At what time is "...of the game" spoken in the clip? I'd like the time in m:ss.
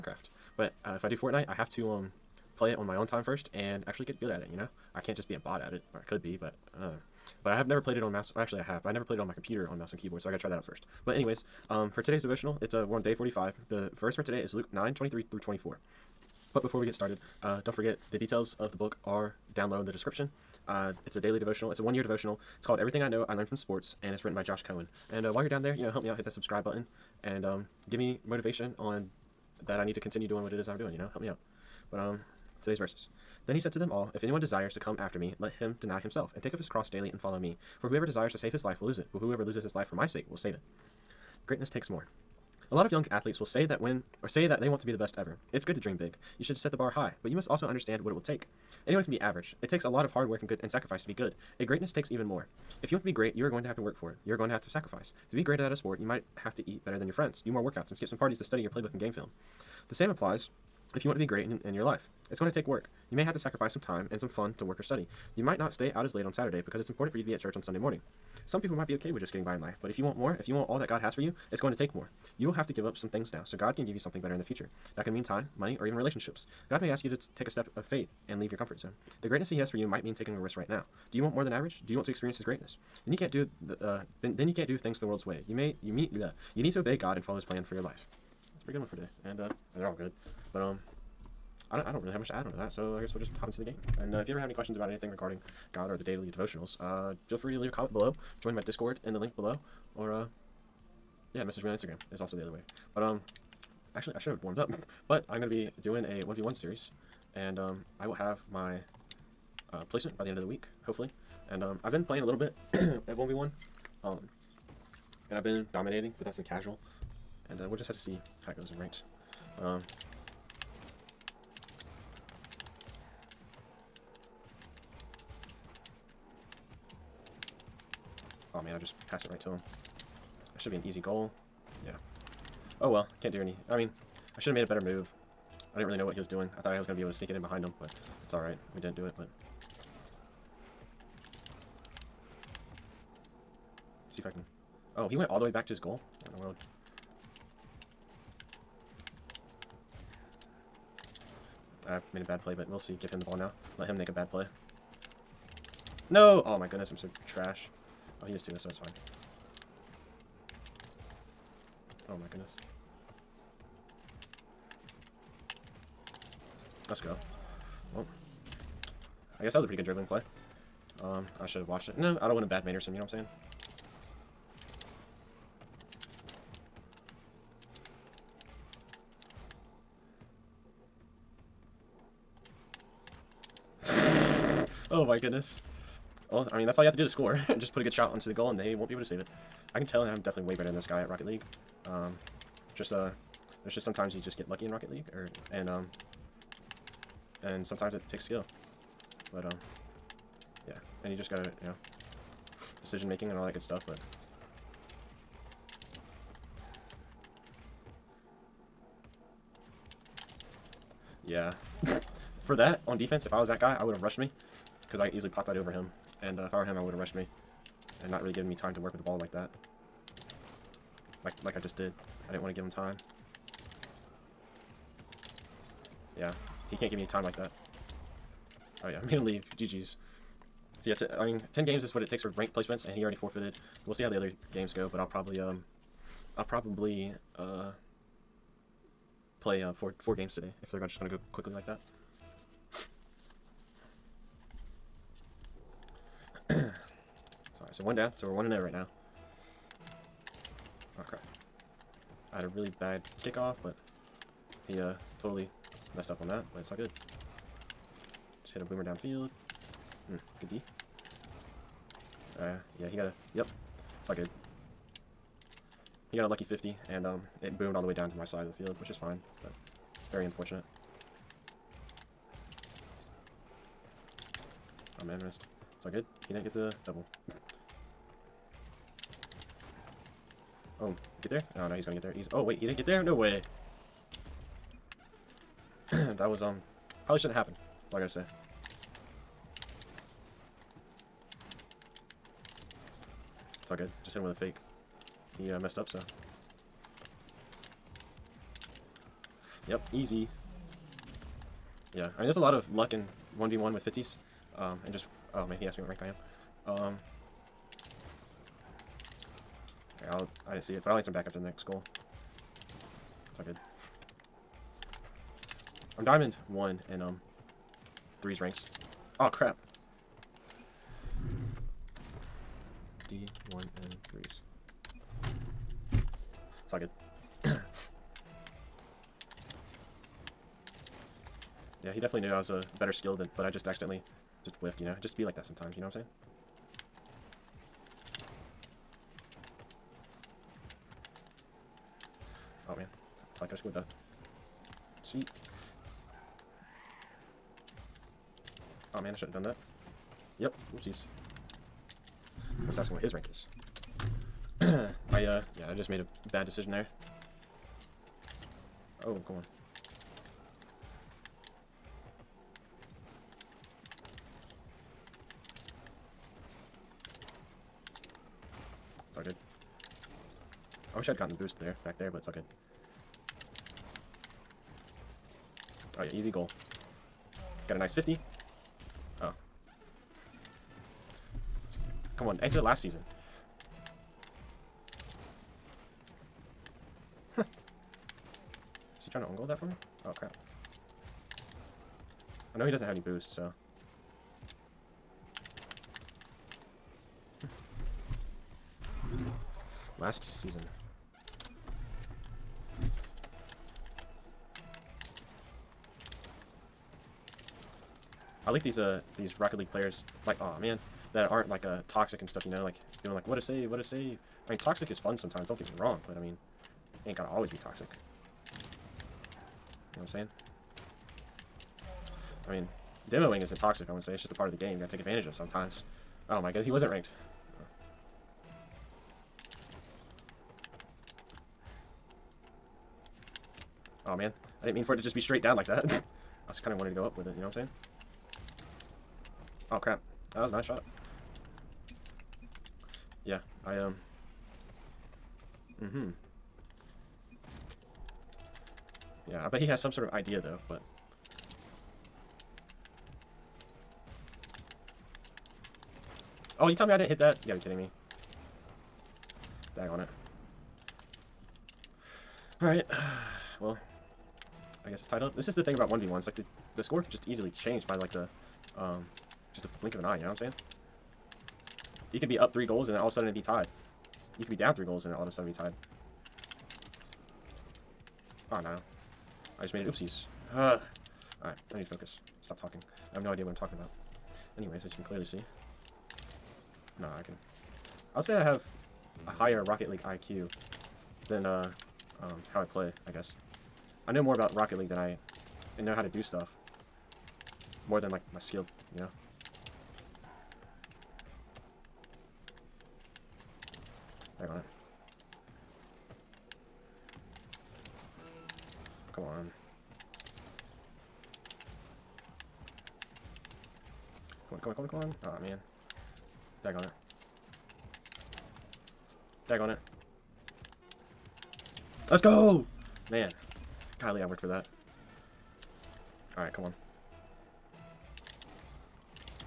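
7:04.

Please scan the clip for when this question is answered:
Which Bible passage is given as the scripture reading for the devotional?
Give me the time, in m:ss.
0:14.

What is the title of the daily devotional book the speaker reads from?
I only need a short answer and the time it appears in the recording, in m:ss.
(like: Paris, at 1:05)
Everything I Know I Learned from Sports, at 0:22.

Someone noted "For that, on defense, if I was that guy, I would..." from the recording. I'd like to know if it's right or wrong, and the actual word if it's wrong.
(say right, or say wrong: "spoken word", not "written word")
right.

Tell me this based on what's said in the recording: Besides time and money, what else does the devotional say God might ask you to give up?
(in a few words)
relationships.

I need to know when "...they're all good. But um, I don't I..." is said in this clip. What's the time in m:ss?
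1:29.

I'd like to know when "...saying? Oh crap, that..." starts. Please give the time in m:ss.
7:17.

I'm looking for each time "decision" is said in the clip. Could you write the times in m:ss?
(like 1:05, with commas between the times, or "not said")
3:22, 5:56.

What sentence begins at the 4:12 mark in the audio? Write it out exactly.
had a really bad kickoff, but he uh, totally messed up on that, but it's all good.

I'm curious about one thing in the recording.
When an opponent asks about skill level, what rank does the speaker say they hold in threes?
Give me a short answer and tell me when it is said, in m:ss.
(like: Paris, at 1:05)
Diamond 1, at 5:16.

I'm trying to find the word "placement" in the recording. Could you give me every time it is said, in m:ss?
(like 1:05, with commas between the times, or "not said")
1:49, 3:52.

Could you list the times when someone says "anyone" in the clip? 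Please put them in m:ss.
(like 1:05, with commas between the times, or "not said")
0:34, 0:48.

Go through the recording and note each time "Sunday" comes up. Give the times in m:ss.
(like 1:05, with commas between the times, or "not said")
1:07.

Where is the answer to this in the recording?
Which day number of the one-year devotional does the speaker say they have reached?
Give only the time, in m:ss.
0:13.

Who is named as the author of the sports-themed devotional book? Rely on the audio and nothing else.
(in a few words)
Josh Coan.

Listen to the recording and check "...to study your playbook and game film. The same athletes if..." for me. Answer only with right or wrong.
wrong.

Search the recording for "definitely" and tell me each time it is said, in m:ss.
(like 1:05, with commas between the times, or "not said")
3:10, 5:31.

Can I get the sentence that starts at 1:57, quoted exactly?
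And uh, we'll just have to see how it goes in ranked.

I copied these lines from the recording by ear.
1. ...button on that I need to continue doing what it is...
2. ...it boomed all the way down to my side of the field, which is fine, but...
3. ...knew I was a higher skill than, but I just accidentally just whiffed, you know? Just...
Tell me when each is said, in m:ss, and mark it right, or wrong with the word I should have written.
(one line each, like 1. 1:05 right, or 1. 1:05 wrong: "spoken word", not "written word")
1. 0:28 wrong: "motivation", not "button"
2. 4:27 right
3. 5:32 wrong: "better", not "higher".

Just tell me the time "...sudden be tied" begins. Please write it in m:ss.
7:55.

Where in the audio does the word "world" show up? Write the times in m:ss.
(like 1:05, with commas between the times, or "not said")
1:25, 2:26.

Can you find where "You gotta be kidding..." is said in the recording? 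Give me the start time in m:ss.
7:37.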